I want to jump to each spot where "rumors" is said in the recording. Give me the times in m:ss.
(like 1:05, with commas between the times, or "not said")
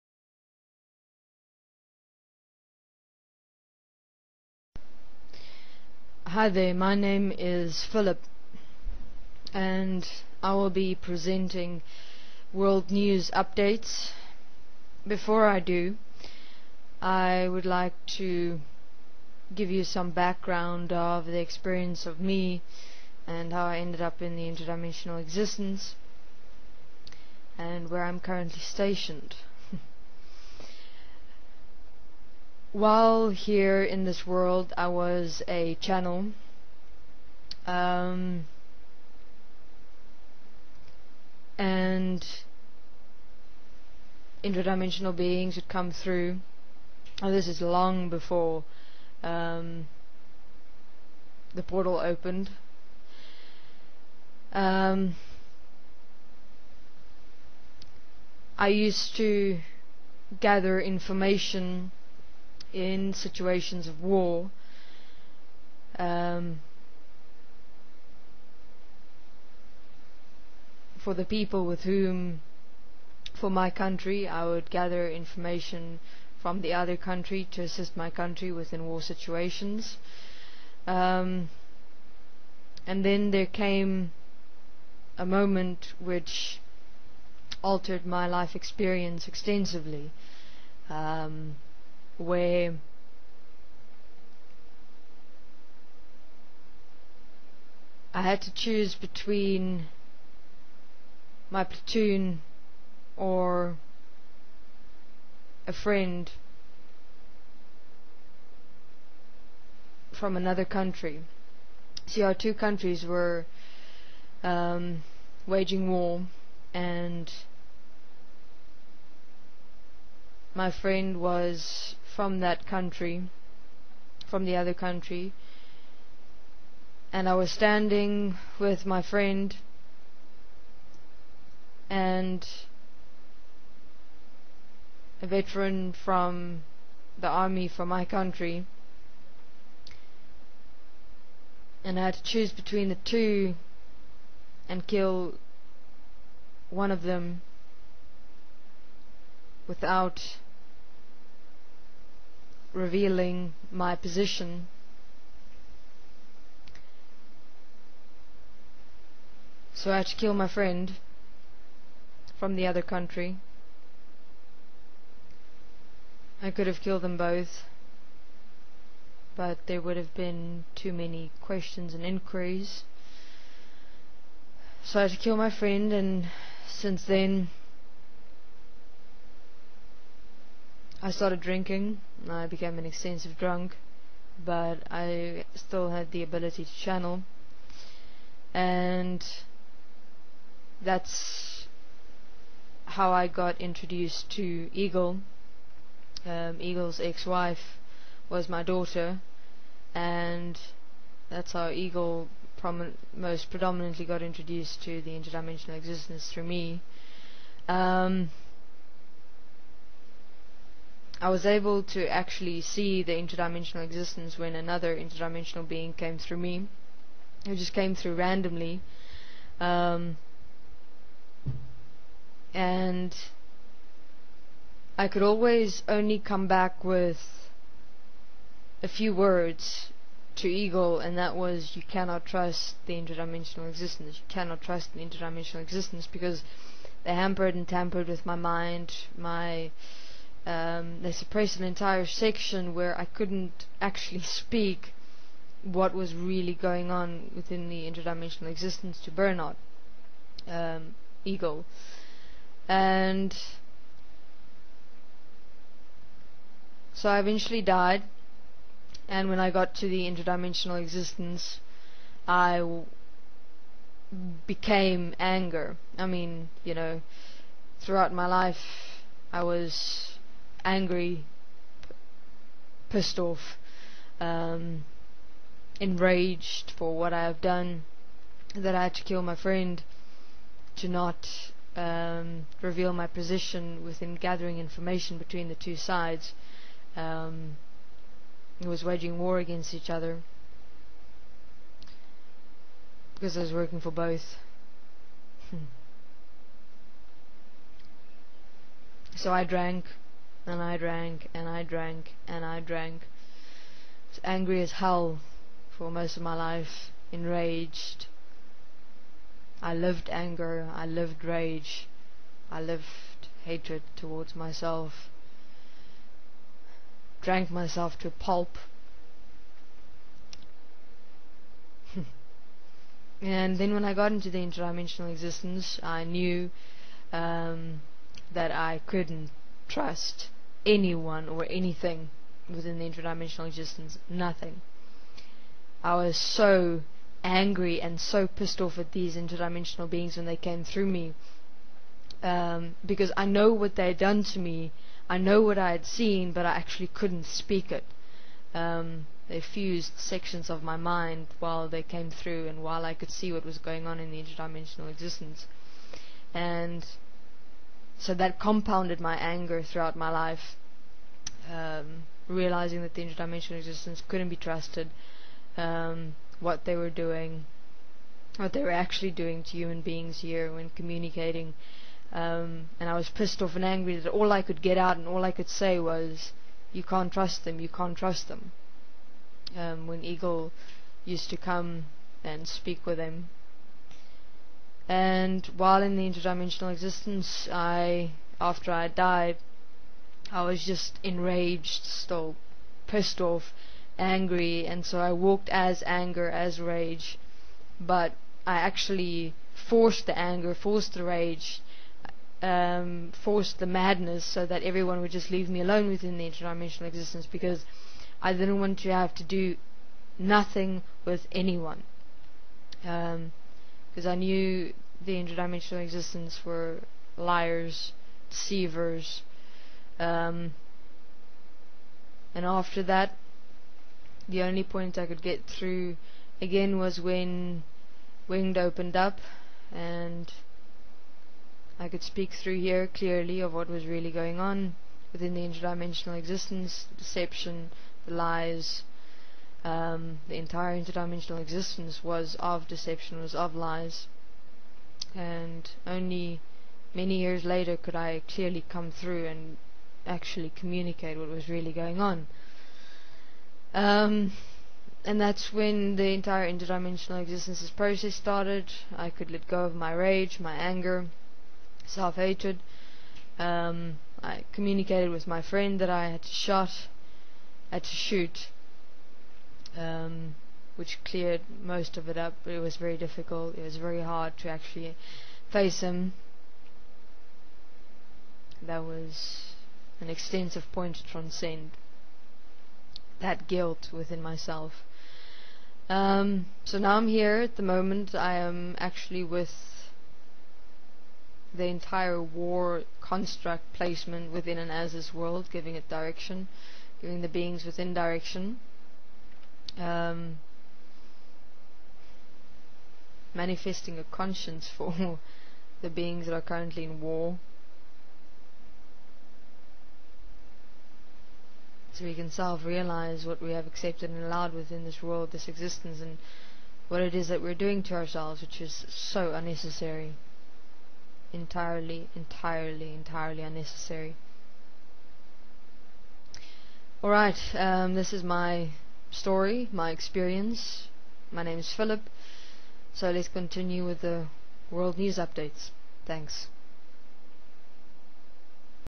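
not said.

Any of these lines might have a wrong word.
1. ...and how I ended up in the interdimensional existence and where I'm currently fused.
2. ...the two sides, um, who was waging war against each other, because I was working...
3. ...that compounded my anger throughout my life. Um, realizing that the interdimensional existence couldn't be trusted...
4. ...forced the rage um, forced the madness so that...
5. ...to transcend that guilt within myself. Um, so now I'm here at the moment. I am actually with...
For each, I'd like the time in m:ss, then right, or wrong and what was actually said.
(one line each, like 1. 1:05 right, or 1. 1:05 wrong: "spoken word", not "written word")
1. 0:23 wrong: "stationed", not "fused"
2. 4:45 right
3. 5:58 right
4. 6:40 right
5. 8:00 right.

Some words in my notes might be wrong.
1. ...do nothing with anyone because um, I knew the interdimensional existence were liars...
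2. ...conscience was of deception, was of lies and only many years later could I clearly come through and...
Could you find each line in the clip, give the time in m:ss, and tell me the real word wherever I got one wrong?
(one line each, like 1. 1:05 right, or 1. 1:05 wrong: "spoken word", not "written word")
1. 6:49 right
2. 7:21 wrong: "existence", not "conscience".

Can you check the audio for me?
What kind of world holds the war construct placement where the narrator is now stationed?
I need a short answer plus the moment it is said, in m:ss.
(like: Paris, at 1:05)
an Asis world, at 8:14.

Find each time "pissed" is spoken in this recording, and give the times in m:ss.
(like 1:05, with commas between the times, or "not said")
4:32, 5:38, 6:13, 6:32.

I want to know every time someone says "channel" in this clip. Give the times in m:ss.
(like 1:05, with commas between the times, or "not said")
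0:35, 3:06.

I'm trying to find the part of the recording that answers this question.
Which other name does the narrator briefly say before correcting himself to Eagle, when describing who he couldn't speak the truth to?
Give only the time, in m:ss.
4:09.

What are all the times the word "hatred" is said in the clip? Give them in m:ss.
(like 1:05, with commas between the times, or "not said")
5:13, 7:42.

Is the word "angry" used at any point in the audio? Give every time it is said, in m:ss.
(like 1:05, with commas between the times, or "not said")
4:30, 5:04, 5:37, 6:13, 6:33.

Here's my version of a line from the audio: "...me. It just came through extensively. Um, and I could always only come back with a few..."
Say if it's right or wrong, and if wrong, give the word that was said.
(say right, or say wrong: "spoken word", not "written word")
wrong: "randomly", not "extensively".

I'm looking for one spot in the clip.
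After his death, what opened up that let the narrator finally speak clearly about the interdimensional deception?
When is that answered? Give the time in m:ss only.
7:08.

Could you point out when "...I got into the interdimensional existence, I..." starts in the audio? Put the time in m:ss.
5:23.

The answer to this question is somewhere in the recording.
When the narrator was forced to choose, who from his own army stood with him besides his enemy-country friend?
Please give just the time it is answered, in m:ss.
2:15.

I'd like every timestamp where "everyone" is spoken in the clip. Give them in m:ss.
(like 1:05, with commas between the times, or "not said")
6:44.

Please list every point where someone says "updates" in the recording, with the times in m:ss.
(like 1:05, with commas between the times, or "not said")
0:13, 8:55.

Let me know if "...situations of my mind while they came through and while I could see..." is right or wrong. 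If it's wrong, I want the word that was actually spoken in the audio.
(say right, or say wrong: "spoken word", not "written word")
wrong: "sections", not "situations".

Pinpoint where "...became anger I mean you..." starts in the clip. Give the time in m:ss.
4:24.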